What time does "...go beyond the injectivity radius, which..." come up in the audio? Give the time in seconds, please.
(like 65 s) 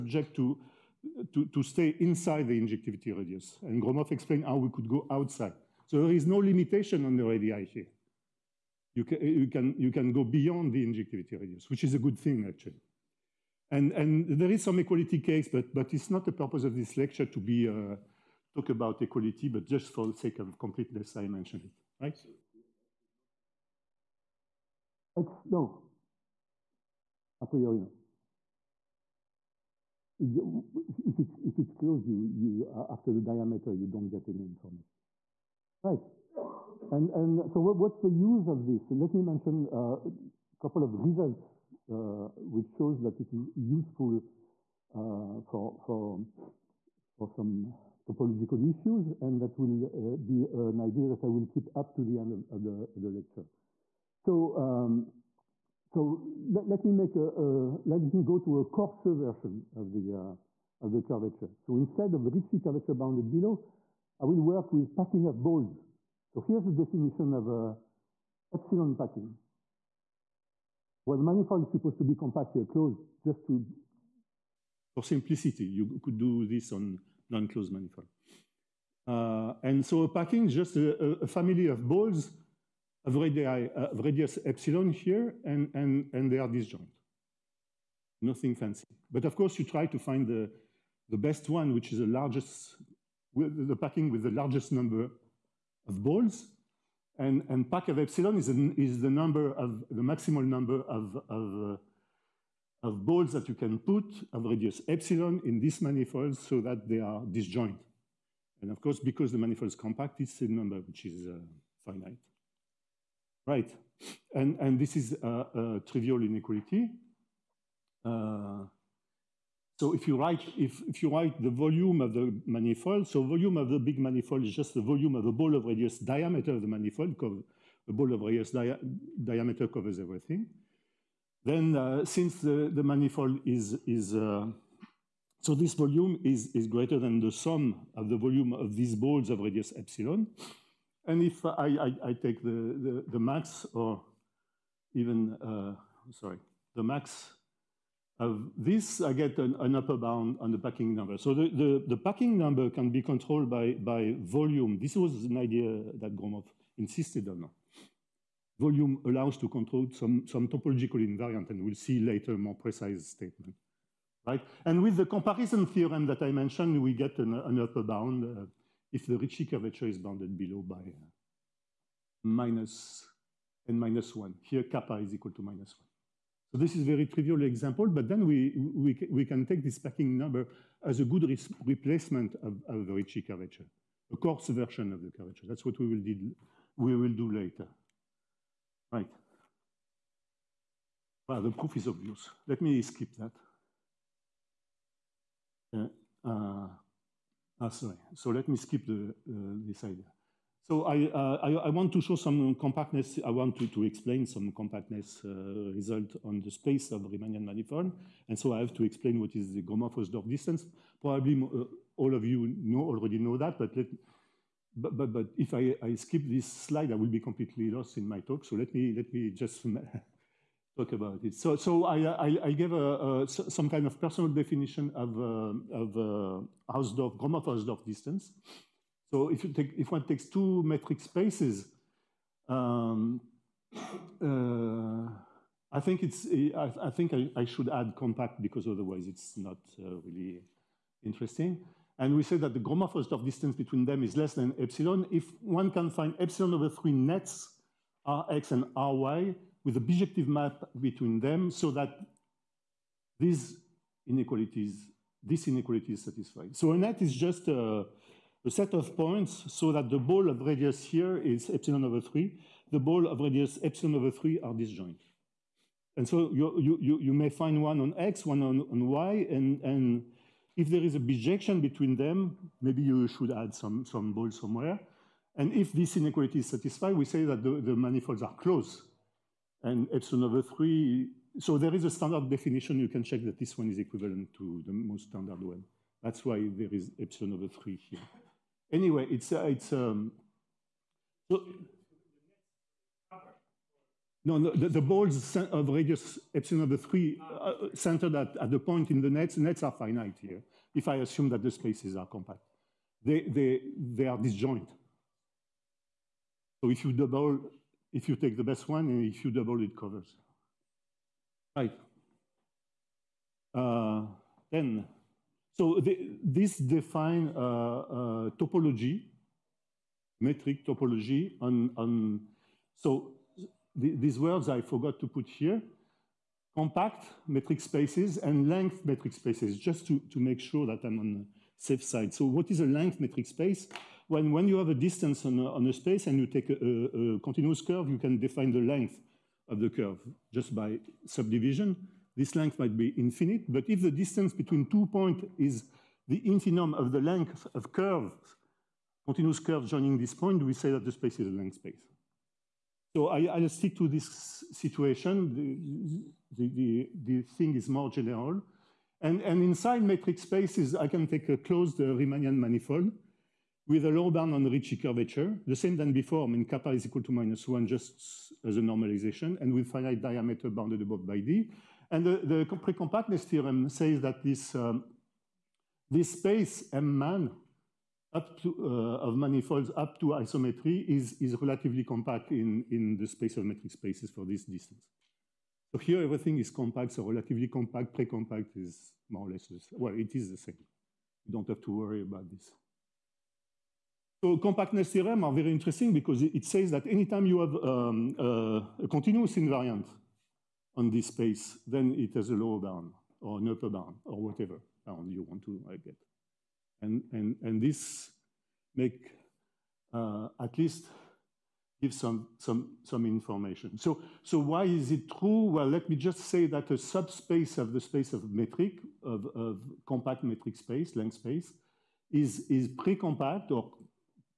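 10 s.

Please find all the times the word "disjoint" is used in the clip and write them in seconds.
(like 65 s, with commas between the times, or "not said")
86 s, 107 s, 264 s, 304 s.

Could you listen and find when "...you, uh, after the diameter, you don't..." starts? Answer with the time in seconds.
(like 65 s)
32 s.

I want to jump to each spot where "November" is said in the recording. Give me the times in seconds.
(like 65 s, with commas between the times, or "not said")
not said.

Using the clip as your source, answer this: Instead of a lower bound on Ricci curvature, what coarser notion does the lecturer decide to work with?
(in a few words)
packing of balls.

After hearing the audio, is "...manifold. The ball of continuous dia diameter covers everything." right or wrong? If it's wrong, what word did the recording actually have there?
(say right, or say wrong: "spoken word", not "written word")
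wrong: "radius", not "continuous".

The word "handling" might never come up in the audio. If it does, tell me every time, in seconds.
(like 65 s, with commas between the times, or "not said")
not said.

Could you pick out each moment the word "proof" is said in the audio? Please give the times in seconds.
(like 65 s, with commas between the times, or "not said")
191 s.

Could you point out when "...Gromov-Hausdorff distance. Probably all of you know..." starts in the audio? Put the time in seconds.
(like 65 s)
209 s.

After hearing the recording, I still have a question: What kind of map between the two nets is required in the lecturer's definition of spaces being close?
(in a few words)
bijective map.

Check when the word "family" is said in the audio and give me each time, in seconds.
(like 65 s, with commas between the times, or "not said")
81 s.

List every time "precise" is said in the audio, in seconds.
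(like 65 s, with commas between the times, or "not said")
162 s.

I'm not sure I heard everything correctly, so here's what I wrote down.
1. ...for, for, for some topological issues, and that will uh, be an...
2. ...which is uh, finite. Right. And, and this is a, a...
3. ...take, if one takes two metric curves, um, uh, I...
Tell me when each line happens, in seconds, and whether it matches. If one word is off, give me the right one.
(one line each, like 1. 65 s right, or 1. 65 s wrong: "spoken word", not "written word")
1. 45 s right
2. 110 s right
3. 229 s wrong: "spaces", not "curves".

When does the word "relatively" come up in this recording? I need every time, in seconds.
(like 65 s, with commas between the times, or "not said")
381 s, 387 s.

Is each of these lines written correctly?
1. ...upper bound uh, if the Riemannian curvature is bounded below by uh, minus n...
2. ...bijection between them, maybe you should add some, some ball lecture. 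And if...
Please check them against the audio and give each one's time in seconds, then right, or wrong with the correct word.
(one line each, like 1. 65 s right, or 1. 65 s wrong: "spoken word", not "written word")
1. 167 s wrong: "Ricci", not "Riemannian"
2. 270 s wrong: "somewhere", not "lecture".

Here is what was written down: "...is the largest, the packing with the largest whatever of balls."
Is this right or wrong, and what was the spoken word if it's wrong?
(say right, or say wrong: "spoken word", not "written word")
wrong: "number", not "whatever".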